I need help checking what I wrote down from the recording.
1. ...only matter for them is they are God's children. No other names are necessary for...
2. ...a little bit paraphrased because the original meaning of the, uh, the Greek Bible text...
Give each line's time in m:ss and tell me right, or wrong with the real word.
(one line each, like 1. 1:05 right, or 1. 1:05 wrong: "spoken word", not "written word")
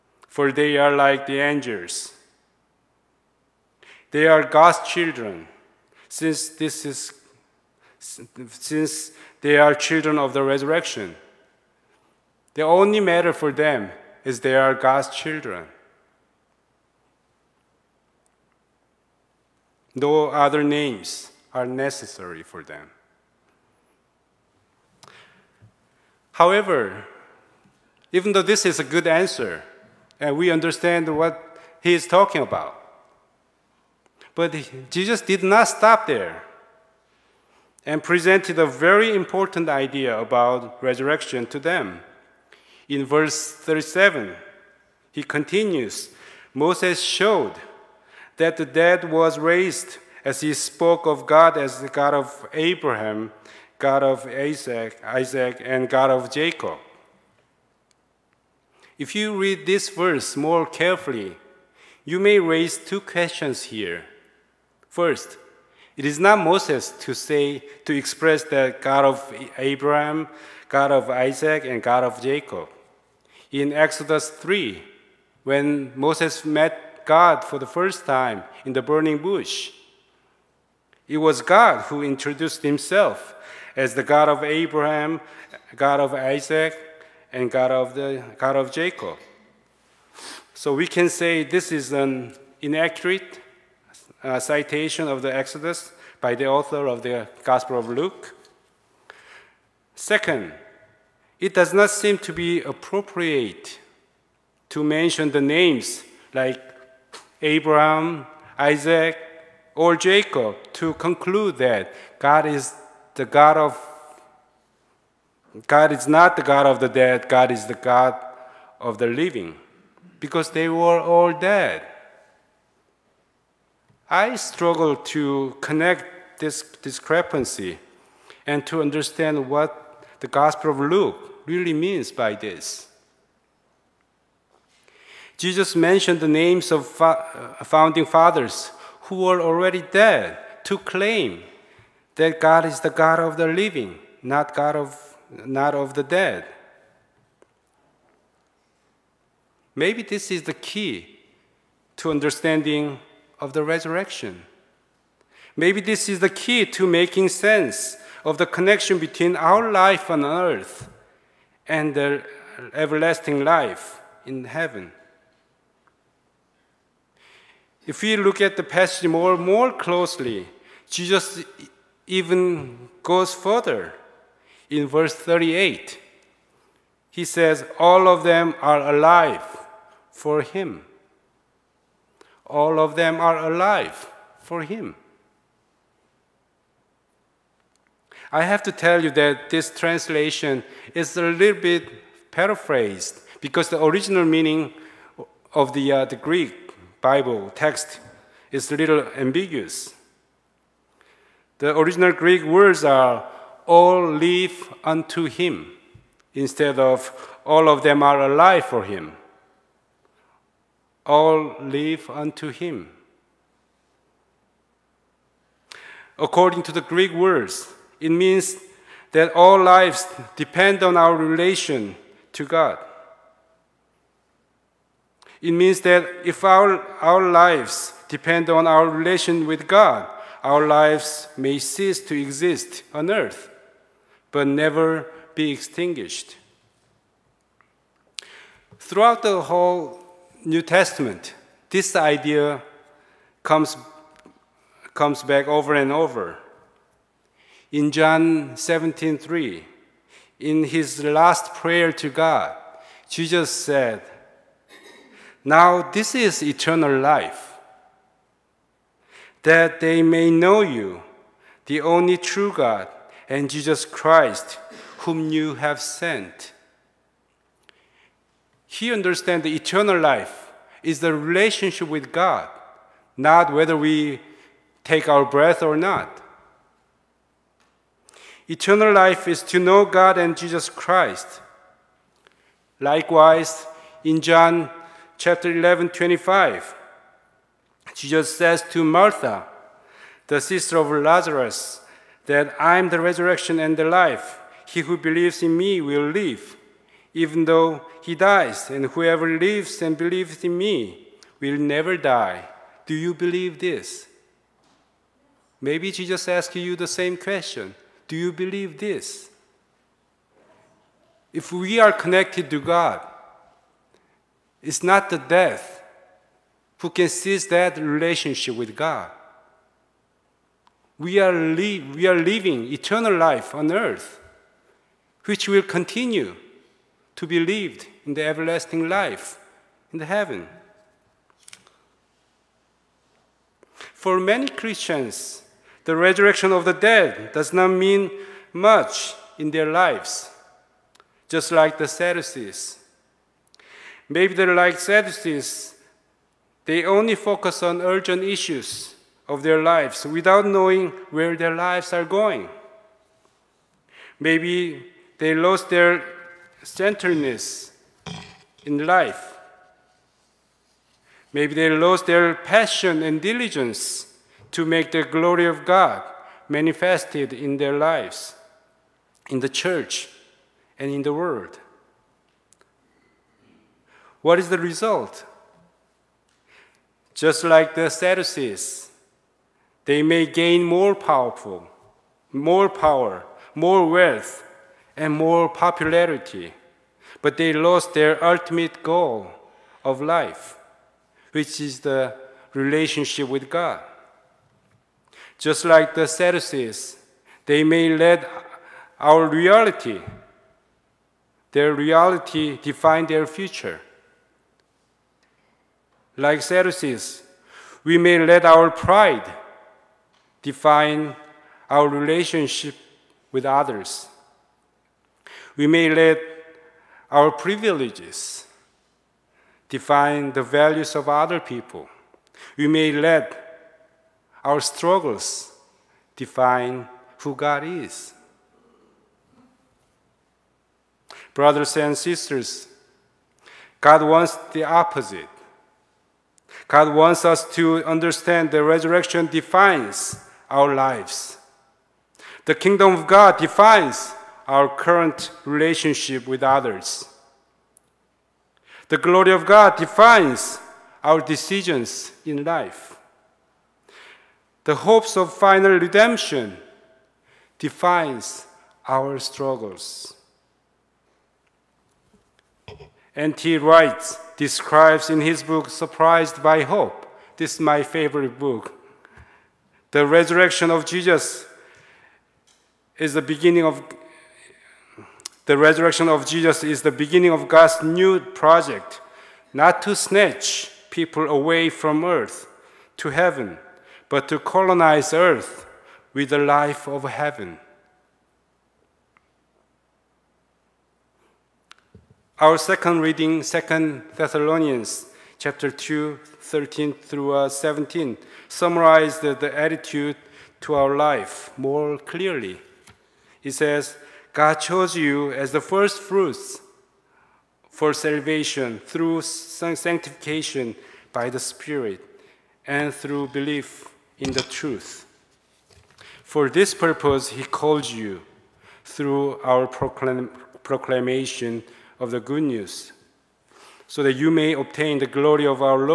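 1. 0:12 right
2. 3:11 right.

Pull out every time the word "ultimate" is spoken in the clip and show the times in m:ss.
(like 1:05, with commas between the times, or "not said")
6:28.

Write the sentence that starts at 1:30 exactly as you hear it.
So we can say this is an inaccurate uh, citation of the Exodus by the author of the Gospel of Luke.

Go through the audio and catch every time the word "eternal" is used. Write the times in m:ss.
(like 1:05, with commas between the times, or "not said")
4:16, 4:29, 4:38, 5:22.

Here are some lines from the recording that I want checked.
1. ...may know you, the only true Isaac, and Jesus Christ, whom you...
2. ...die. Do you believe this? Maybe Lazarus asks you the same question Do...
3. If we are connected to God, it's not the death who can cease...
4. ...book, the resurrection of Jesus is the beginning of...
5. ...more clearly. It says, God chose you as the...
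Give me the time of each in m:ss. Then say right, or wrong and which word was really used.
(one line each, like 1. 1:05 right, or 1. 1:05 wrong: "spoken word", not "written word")
1. 4:20 wrong: "God", not "Isaac"
2. 5:01 wrong: "Jesus", not "Lazarus"
3. 5:11 right
4. 7:48 right
5. 8:21 right.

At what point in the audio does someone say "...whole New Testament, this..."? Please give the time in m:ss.
3:59.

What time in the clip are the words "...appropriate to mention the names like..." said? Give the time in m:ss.
1:42.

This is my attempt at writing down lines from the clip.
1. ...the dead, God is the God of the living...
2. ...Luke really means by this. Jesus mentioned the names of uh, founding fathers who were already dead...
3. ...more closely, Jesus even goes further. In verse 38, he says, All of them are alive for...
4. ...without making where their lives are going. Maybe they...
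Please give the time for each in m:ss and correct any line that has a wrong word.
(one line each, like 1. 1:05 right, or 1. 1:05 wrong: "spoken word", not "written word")
1. 1:56 right
2. 2:10 right
3. 2:49 right
4. 5:50 wrong: "knowing", not "making".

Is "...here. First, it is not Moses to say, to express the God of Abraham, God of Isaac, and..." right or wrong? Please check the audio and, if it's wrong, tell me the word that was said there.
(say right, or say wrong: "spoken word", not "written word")
right.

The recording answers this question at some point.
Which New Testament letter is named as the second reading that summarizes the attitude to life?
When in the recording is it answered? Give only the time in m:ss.
8:13.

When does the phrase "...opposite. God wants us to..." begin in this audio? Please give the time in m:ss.
7:14.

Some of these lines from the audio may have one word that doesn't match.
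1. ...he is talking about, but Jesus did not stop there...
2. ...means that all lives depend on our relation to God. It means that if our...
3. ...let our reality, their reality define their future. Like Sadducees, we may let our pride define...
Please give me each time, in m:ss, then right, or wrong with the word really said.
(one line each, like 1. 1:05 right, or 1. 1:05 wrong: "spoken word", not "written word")
1. 0:31 right
2. 3:38 right
3. 6:37 right.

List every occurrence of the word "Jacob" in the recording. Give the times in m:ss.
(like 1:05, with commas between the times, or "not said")
0:56, 1:12, 1:28, 1:49.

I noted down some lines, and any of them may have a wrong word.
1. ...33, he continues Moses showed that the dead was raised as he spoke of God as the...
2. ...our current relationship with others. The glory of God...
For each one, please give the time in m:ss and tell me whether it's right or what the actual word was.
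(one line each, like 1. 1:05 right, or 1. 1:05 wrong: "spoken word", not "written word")
1. 0:43 wrong: "37", not "33"
2. 7:24 right.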